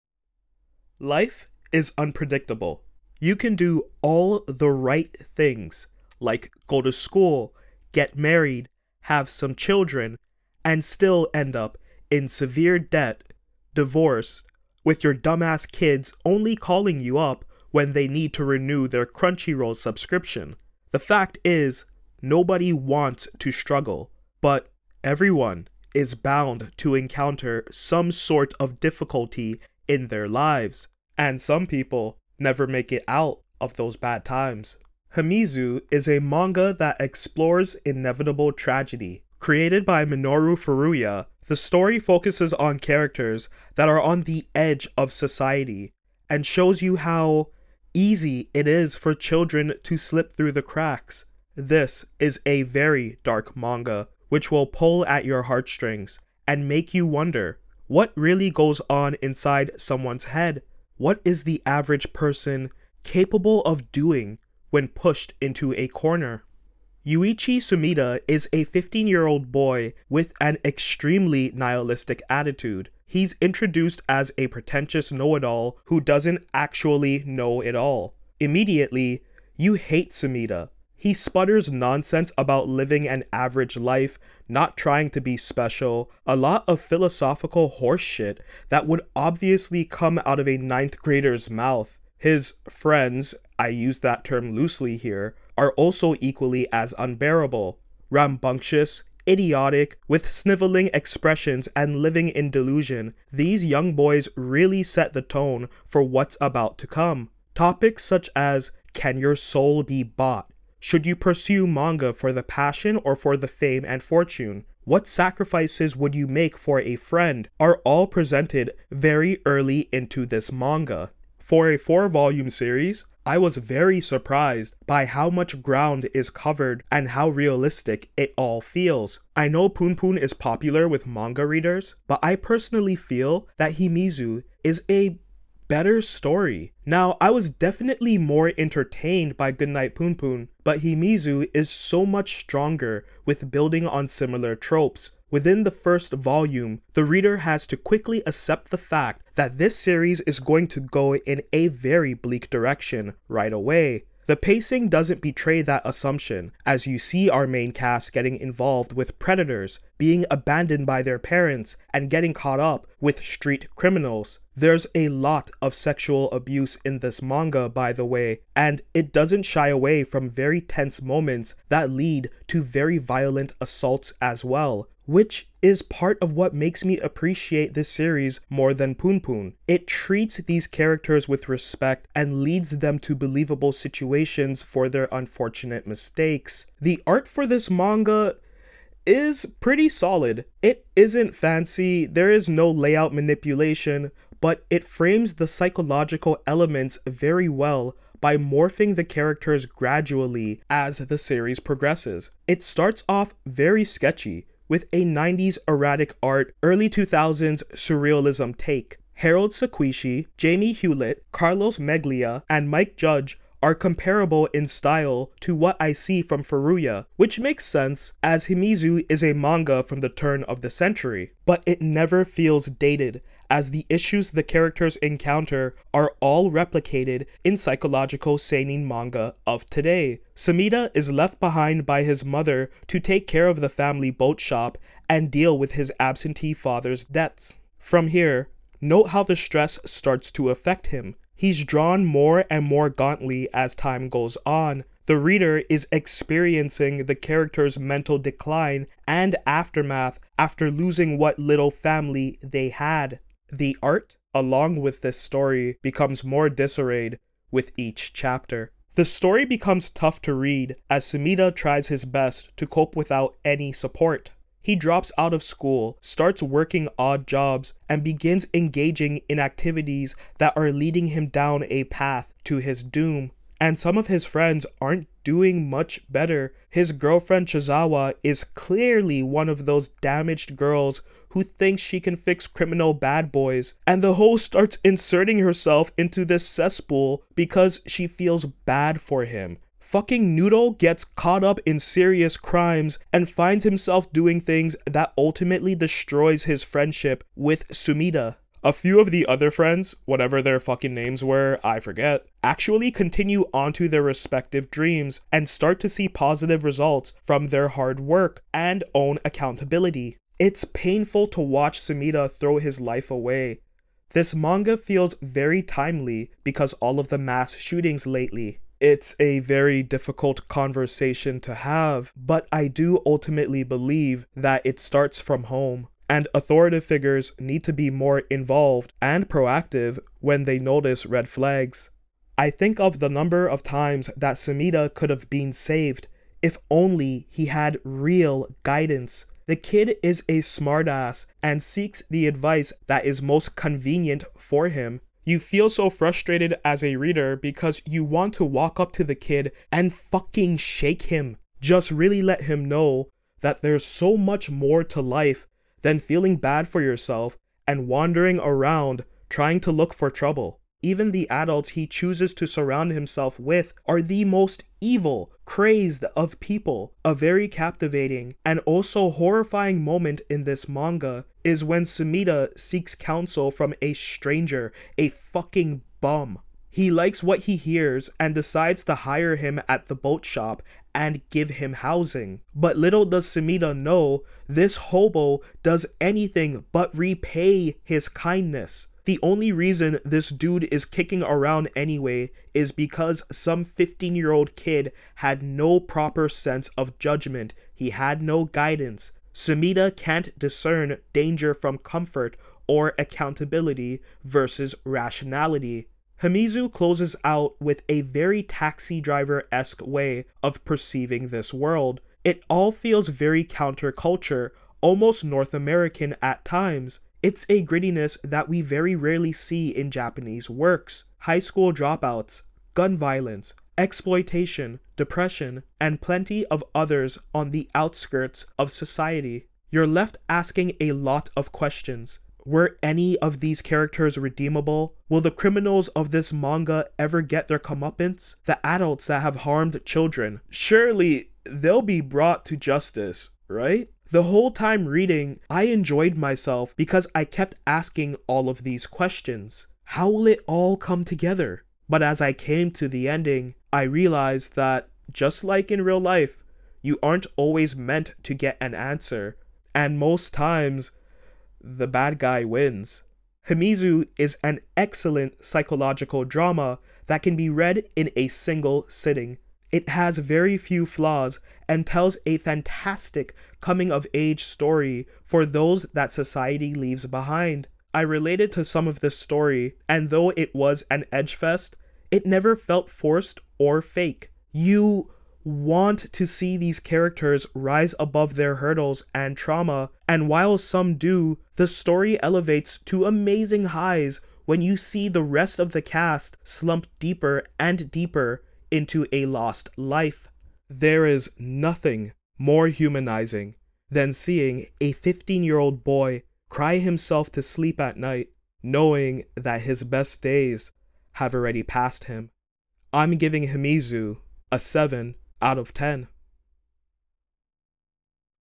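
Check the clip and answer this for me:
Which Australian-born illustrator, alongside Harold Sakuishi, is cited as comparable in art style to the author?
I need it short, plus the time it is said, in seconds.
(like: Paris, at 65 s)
Jamie Hewlett, at 210 s.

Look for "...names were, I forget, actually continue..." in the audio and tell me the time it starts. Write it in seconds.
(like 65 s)
300 s.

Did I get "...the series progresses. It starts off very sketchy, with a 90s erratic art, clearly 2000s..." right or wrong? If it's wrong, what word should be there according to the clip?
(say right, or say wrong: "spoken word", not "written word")
wrong: "early", not "clearly".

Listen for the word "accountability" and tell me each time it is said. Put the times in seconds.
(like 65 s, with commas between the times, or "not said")
309 s, 402 s.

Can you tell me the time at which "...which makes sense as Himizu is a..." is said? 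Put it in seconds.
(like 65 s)
217 s.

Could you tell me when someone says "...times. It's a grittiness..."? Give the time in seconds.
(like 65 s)
416 s.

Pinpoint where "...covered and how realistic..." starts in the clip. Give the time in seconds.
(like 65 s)
126 s.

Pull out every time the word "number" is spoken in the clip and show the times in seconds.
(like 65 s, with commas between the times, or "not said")
333 s.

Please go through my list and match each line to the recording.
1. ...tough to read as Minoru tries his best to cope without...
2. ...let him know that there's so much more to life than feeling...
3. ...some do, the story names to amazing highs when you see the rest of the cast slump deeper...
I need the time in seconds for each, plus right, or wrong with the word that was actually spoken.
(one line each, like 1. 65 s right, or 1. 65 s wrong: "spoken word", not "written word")
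1. 259 s wrong: "Sumida", not "Minoru"
2. 352 s right
3. 490 s wrong: "elevates", not "names".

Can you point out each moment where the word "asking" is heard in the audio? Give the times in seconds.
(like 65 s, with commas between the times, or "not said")
430 s, 447 s.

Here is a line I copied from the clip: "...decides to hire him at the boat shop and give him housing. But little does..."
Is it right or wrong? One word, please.
right.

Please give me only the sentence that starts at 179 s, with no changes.
It treats these characters with respect and leads them to believable situations for their unfortunate mistakes.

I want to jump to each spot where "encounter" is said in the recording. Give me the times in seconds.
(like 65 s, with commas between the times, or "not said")
26 s, 224 s.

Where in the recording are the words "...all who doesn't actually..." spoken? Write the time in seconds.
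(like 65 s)
75 s.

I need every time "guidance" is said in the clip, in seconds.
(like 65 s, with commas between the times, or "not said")
338 s, 398 s.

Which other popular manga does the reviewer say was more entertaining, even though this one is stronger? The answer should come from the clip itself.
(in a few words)
Goodnight Punpun.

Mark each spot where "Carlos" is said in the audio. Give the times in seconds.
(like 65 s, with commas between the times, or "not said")
211 s.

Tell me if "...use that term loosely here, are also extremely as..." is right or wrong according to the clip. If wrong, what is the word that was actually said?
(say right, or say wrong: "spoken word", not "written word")
wrong: "equally", not "extremely".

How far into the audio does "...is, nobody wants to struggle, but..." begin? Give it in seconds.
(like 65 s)
21 s.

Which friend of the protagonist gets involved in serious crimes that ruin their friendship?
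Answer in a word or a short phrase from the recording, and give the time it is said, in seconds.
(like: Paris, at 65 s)
Noodle, at 290 s.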